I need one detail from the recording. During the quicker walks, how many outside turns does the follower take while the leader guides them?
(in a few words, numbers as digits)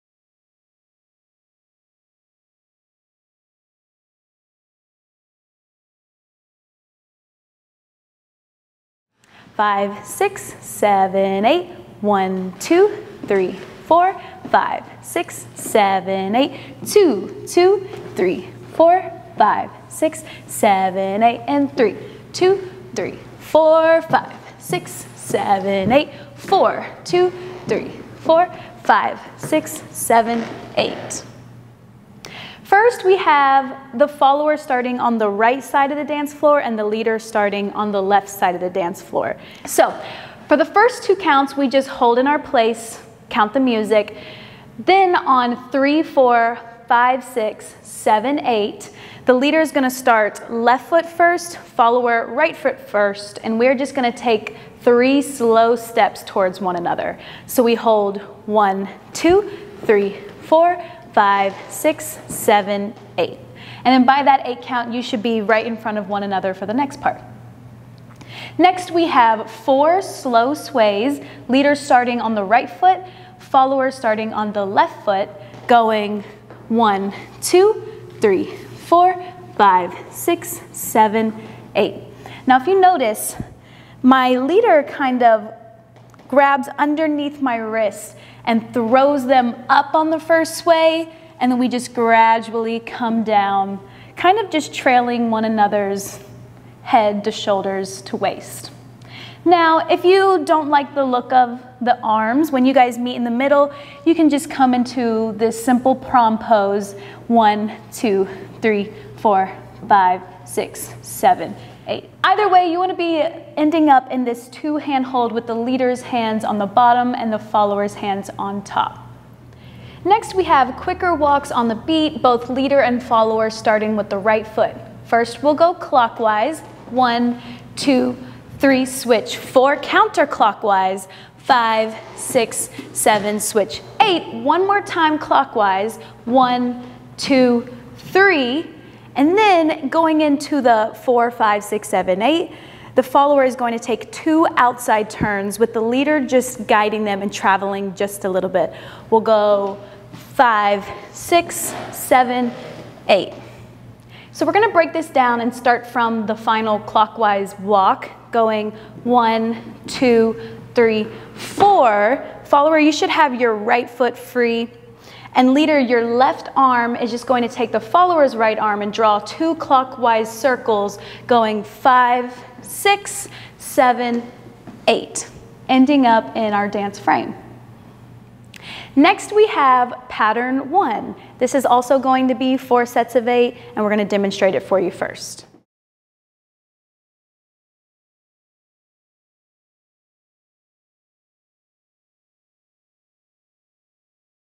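2.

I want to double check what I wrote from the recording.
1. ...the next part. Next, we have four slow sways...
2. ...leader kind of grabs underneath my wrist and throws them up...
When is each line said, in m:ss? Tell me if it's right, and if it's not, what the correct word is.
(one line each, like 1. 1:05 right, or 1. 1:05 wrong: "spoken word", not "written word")
1. 1:06 right
2. 1:24 right.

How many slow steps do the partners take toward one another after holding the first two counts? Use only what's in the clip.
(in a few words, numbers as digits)
3.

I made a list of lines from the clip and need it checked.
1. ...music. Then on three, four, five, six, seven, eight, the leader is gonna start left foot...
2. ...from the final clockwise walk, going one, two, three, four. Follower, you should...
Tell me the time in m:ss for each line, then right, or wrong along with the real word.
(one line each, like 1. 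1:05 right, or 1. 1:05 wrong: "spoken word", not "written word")
1. 0:43 right
2. 2:35 right.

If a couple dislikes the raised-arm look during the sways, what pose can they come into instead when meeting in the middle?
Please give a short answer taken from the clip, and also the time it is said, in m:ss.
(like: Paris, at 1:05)
Prom pose, at 1:45.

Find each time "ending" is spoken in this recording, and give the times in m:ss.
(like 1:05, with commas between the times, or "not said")
1:53, 2:55.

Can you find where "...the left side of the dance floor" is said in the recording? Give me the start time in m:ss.
0:37.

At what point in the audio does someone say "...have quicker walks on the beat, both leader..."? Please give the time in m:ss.
2:00.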